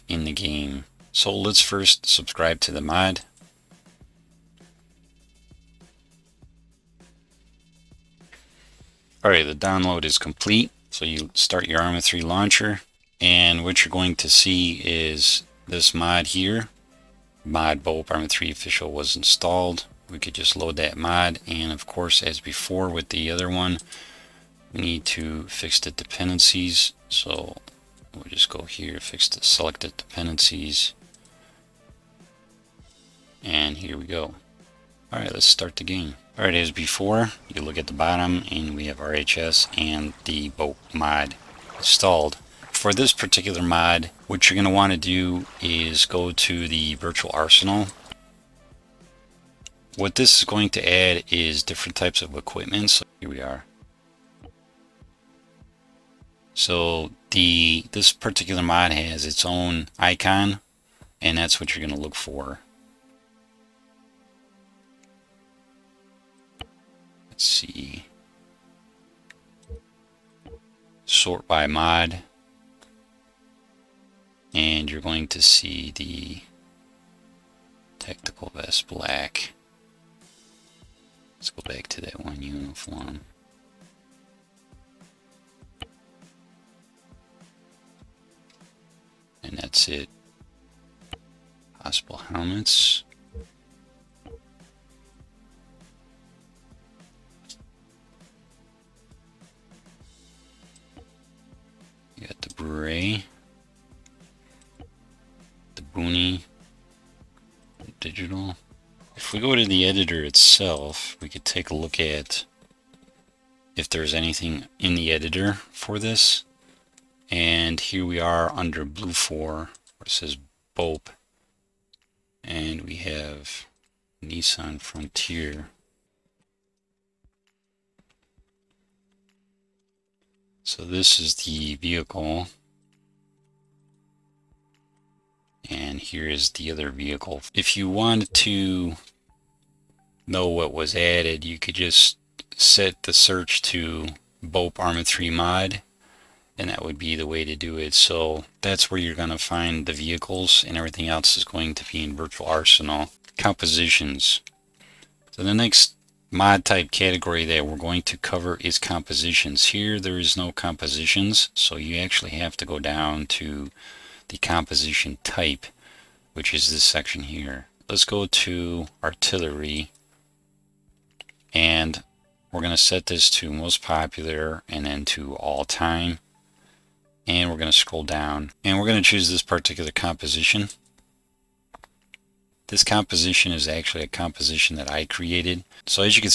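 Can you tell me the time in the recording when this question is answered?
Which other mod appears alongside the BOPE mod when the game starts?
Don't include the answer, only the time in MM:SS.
00:38.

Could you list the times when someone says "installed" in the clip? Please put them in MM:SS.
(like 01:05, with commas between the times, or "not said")
00:19, 00:41.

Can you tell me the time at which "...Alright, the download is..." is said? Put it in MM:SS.
00:09.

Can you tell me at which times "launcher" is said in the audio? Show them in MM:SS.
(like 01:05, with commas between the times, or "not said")
00:12.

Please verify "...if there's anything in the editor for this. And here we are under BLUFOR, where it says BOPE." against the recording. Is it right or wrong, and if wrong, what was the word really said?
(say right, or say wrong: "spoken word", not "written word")
right.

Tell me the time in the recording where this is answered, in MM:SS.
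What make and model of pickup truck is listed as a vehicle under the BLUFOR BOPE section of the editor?
02:04.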